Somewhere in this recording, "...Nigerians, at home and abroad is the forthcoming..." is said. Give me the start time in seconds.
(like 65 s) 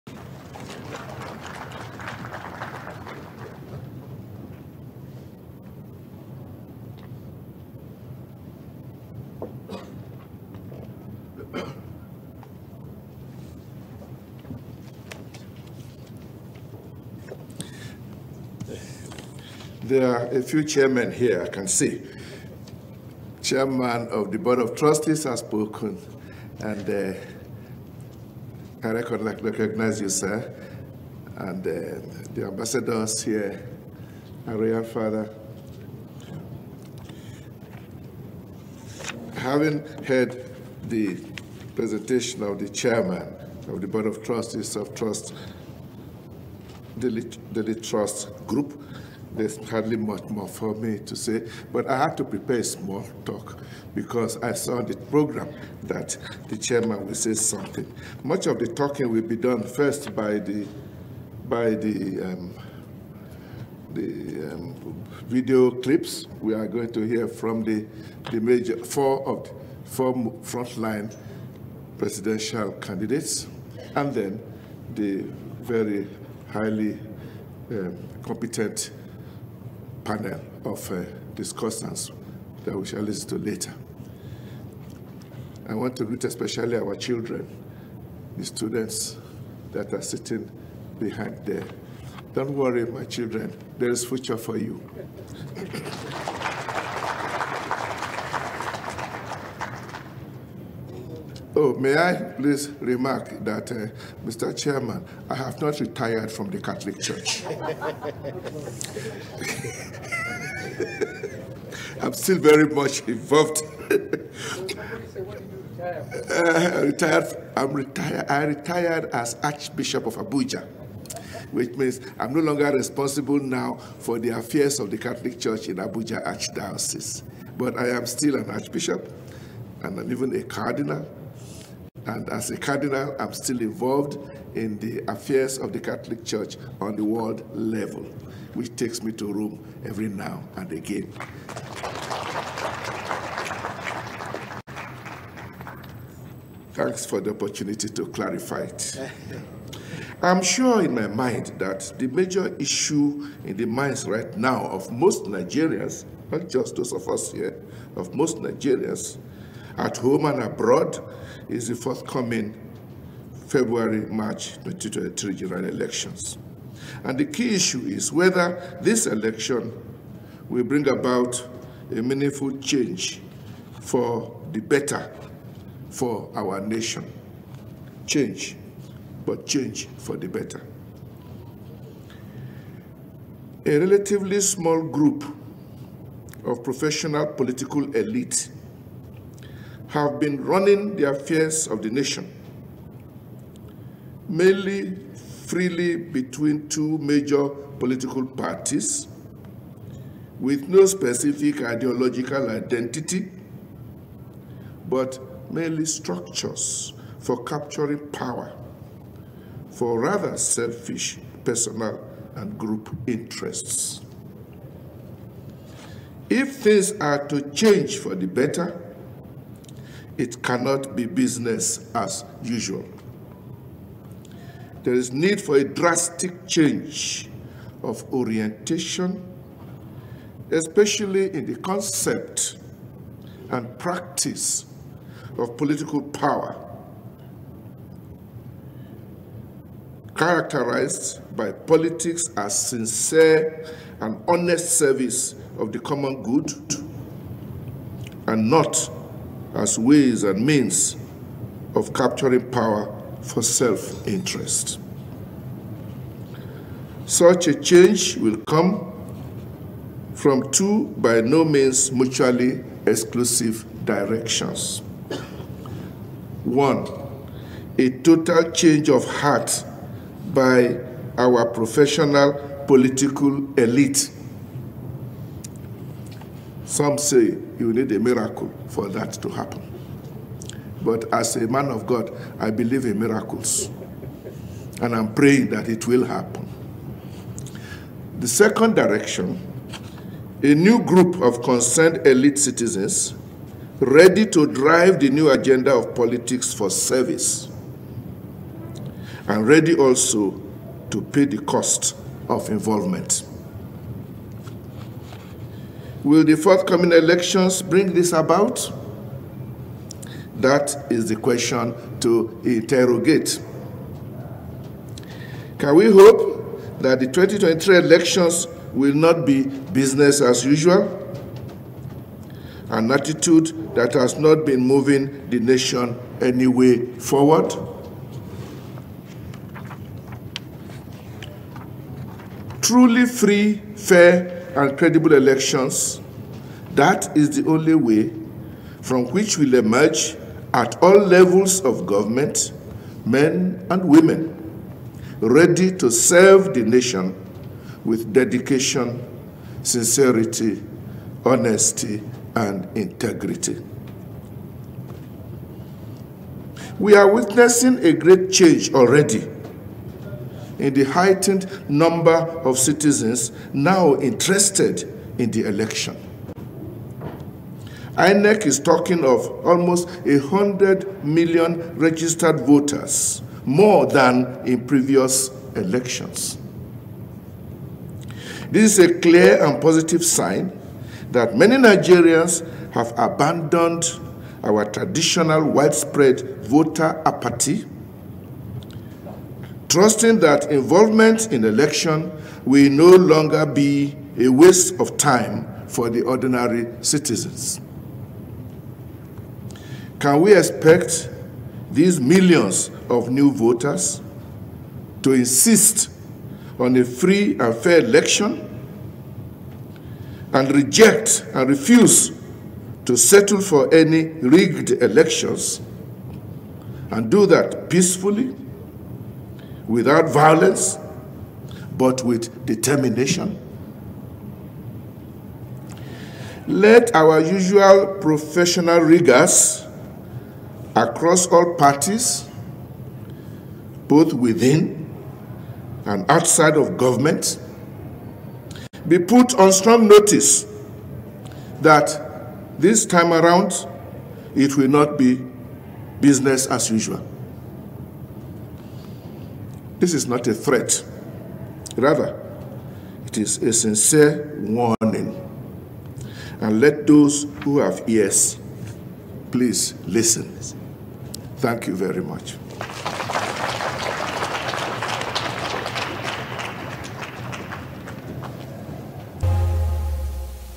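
158 s.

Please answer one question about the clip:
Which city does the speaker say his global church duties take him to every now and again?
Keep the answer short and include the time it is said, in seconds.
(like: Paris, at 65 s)
Rome, at 139 s.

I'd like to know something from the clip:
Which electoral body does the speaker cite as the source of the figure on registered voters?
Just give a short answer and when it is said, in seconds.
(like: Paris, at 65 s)
INEC, at 367 s.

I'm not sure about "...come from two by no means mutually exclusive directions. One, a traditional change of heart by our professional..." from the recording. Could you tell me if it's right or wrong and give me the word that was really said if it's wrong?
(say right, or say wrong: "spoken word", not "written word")
wrong: "total", not "traditional".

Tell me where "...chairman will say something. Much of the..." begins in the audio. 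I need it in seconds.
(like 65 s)
56 s.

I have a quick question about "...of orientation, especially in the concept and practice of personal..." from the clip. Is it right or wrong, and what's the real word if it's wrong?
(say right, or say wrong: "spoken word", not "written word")
wrong: "political", not "personal".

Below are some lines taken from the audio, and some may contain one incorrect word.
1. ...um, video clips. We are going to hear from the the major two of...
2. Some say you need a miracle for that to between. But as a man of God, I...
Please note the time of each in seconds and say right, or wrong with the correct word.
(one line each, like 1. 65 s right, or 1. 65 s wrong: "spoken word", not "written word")
1. 64 s wrong: "four", not "two"
2. 276 s wrong: "happen", not "between".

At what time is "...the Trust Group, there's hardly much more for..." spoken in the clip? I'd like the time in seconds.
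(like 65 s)
46 s.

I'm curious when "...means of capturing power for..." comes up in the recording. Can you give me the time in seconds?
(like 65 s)
250 s.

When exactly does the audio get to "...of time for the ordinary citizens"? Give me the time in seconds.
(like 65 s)
394 s.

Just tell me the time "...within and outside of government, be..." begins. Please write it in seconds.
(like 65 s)
434 s.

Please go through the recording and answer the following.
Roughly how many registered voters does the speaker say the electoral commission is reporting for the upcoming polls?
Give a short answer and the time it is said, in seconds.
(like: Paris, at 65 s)
100 million, at 370 s.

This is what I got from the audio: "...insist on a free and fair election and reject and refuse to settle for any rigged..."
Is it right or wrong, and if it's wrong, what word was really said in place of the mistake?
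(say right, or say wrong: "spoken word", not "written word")
right.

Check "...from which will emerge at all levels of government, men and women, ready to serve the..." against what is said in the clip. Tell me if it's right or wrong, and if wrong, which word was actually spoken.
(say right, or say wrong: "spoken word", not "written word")
right.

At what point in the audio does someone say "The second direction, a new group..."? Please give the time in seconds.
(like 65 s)
288 s.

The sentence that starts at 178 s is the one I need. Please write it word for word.
Change, but change for the better.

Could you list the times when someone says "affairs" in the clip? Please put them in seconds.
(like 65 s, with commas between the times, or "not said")
124 s, 135 s, 191 s.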